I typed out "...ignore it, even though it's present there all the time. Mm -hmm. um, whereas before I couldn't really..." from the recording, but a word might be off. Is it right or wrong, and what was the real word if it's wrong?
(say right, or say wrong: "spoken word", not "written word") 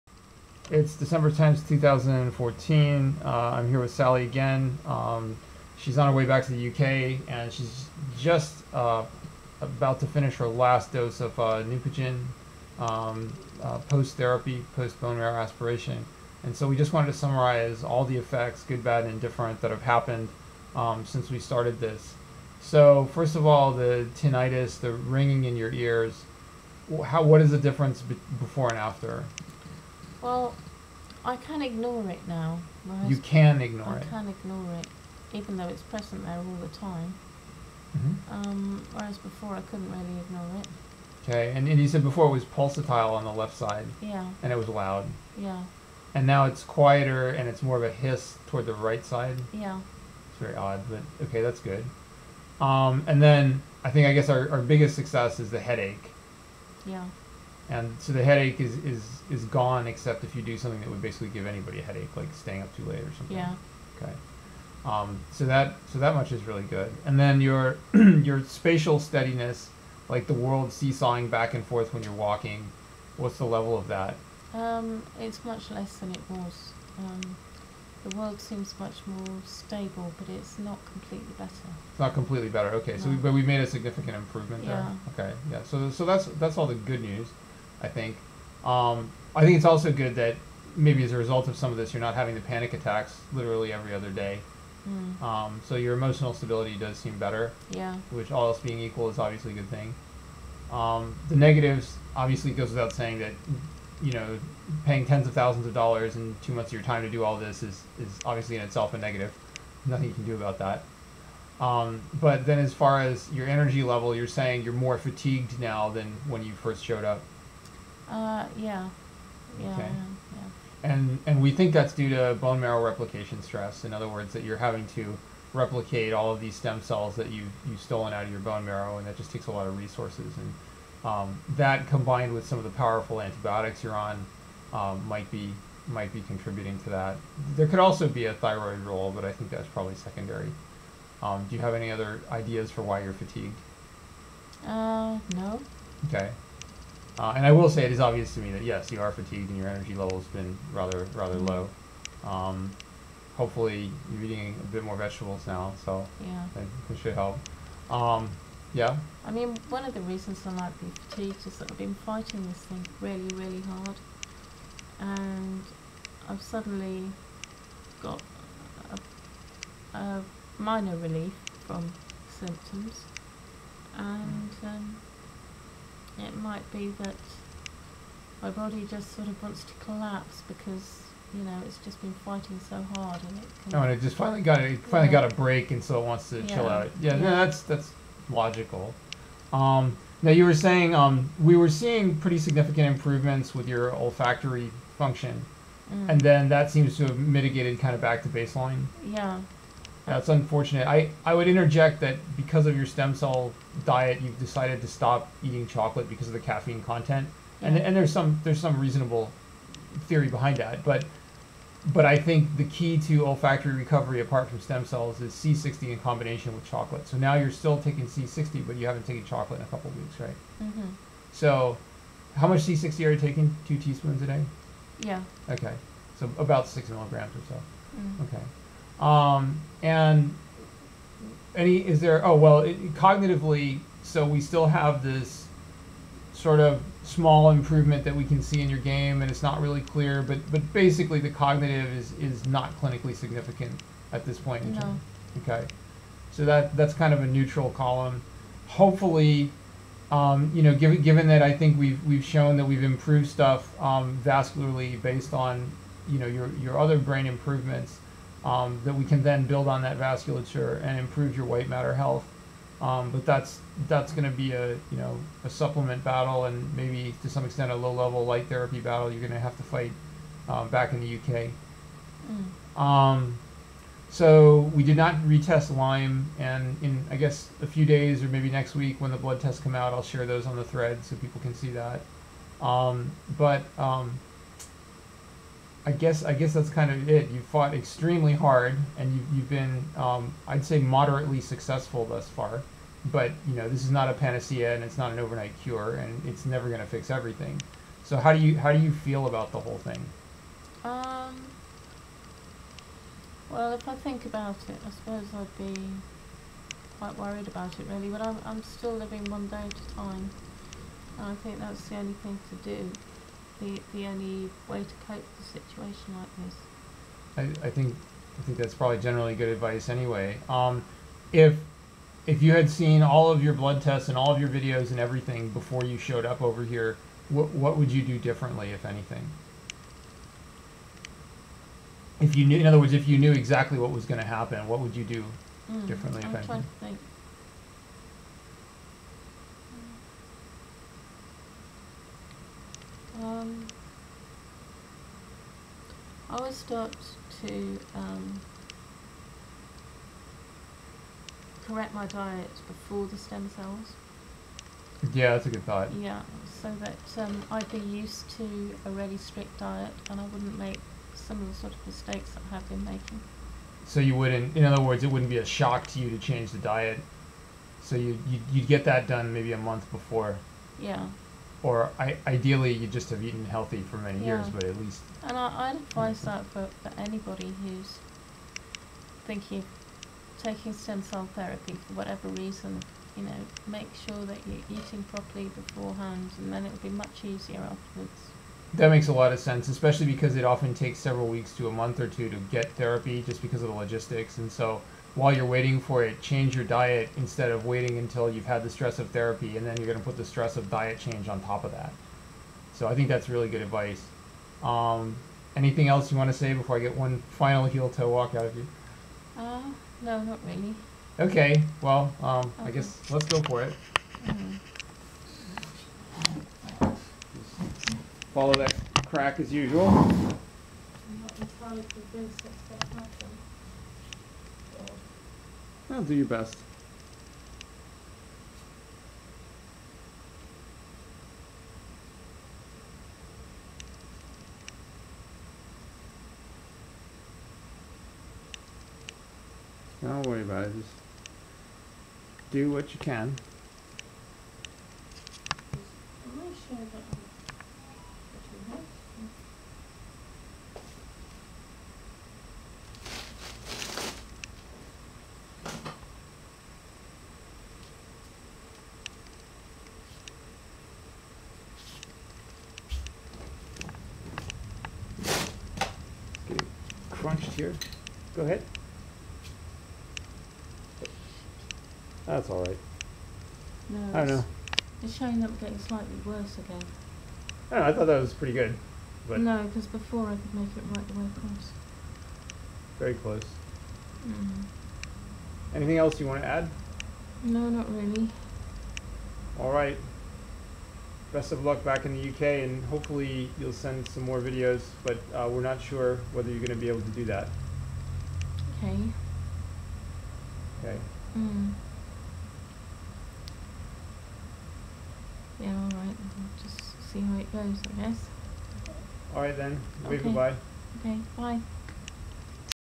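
right.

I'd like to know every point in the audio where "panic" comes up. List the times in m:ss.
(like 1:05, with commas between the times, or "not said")
1:32.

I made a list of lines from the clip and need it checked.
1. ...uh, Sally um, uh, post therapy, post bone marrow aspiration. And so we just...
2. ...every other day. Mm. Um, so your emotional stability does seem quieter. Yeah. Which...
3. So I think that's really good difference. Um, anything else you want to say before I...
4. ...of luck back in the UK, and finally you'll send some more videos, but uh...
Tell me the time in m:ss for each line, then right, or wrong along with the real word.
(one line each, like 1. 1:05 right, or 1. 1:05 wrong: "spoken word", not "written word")
1. 0:11 wrong: "Neupogen", not "Sally"
2. 1:33 wrong: "better", not "quieter"
3. 6:42 wrong: "advice", not "difference"
4. 8:11 wrong: "hopefully", not "finally".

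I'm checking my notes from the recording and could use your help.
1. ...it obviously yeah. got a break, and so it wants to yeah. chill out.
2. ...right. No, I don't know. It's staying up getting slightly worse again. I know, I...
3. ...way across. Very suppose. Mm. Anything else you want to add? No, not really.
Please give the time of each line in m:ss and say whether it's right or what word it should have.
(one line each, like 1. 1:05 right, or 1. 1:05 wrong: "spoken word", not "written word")
1. 3:04 wrong: "finally", not "obviously"
2. 7:52 wrong: "showing", not "staying"
3. 8:01 wrong: "close", not "suppose".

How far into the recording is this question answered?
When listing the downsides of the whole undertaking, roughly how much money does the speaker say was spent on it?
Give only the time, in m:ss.
1:45.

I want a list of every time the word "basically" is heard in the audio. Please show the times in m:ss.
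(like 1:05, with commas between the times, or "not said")
1:01, 4:00.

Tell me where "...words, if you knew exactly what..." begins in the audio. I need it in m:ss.
5:32.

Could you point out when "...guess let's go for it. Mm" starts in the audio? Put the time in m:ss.
6:52.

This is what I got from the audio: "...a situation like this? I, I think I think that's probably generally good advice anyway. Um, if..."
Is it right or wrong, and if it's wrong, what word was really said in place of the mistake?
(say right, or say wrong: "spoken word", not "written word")
right.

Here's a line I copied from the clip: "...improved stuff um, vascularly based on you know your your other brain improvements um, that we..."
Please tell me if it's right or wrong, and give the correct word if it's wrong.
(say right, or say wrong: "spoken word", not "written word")
right.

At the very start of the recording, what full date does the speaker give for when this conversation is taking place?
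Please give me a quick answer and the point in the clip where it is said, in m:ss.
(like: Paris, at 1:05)
December 10, 2014, at 0:00.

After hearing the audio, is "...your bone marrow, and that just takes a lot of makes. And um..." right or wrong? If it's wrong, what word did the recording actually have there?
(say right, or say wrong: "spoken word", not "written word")
wrong: "resources", not "makes".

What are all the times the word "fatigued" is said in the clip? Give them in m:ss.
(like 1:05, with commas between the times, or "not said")
1:54, 2:23, 2:29, 2:41.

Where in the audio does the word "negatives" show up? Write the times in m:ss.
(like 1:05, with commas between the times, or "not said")
1:41, 1:48.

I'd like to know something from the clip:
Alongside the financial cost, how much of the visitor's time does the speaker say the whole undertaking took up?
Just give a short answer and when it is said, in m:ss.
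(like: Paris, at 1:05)
2 months, at 1:46.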